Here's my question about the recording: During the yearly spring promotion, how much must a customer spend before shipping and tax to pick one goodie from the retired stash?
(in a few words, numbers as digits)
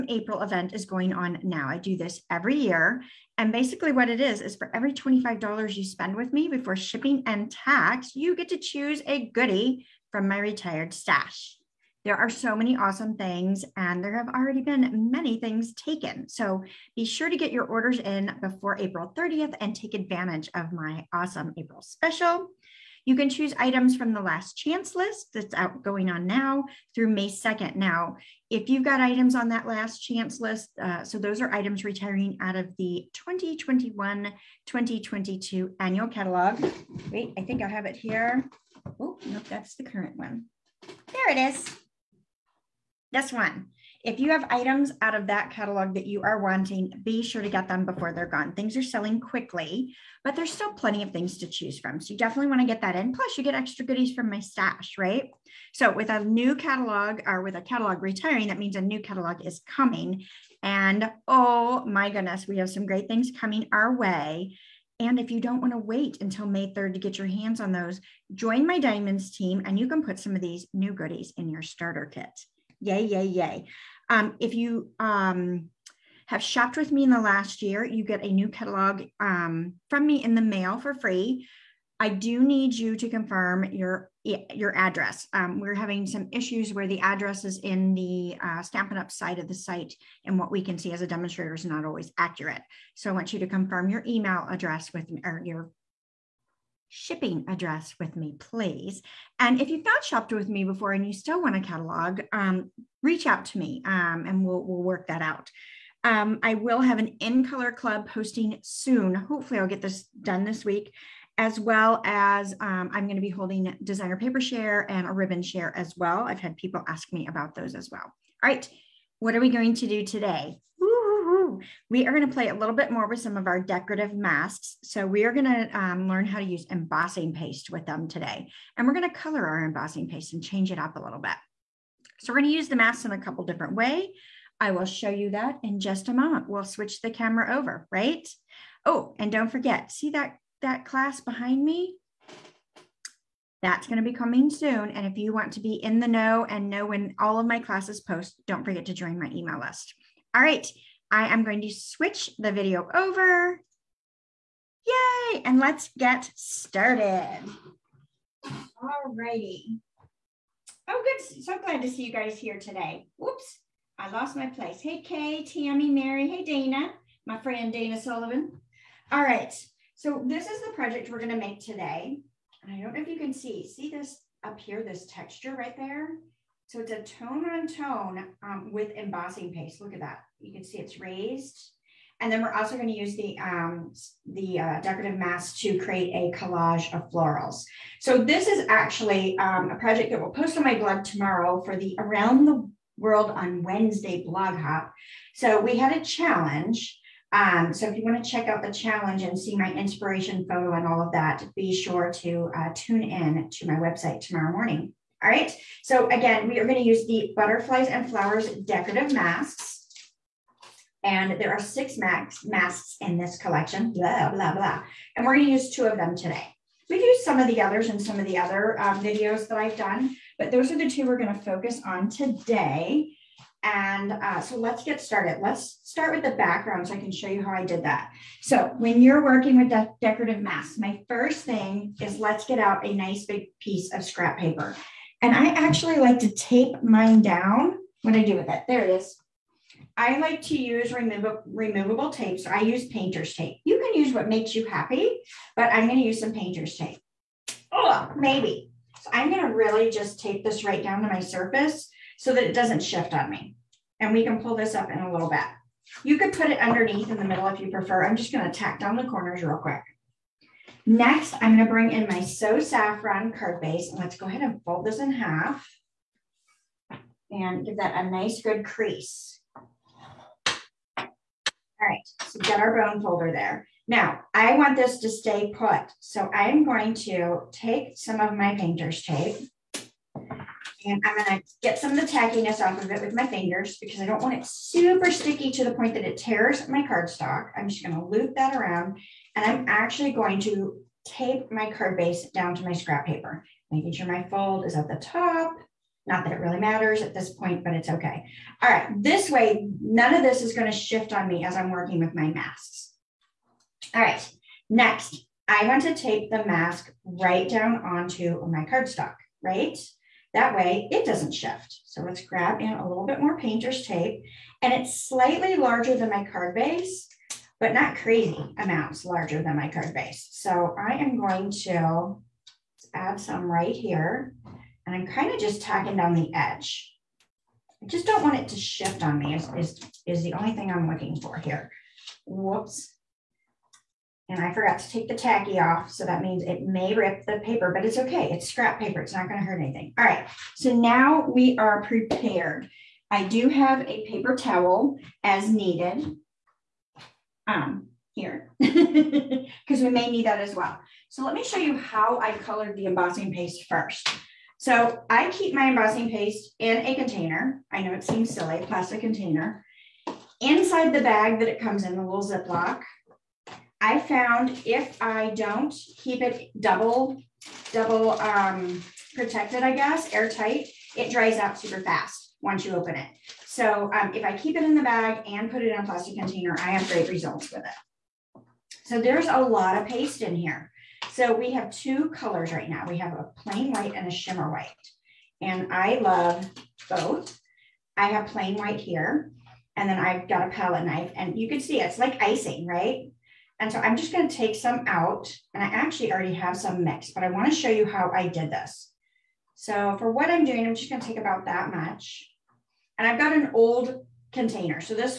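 $25.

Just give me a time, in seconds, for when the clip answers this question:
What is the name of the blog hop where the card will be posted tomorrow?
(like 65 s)
191 s.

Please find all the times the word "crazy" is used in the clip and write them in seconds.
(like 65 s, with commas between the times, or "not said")
317 s.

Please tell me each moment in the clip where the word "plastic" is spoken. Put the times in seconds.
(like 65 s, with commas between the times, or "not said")
358 s, 375 s.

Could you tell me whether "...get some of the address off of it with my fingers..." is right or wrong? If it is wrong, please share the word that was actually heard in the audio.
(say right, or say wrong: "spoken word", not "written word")
wrong: "tackiness", not "address".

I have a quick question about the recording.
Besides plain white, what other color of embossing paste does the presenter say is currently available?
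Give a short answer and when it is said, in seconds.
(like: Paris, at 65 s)
shimmer white, at 384 s.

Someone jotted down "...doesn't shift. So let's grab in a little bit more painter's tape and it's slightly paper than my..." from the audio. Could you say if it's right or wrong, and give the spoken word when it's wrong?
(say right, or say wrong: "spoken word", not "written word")
wrong: "larger", not "paper".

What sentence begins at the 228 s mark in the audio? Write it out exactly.
So when you're working with de decorative masks, my first thing is let's get out a nice big piece of scrap paper.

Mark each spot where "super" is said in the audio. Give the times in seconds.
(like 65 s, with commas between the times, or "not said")
284 s, 371 s.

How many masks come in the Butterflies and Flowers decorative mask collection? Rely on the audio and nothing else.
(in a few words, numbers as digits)
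6.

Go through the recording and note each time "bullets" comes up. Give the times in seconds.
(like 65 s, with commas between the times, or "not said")
not said.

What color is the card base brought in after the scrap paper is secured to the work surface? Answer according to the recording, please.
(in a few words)
So Saffron.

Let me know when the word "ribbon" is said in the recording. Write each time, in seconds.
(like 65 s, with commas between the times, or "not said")
115 s.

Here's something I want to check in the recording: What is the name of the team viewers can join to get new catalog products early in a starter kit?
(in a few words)
Diamonds.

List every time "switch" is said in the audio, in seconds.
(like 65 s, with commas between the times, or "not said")
136 s, 151 s.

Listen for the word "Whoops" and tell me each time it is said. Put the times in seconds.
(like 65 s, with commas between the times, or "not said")
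163 s, 332 s.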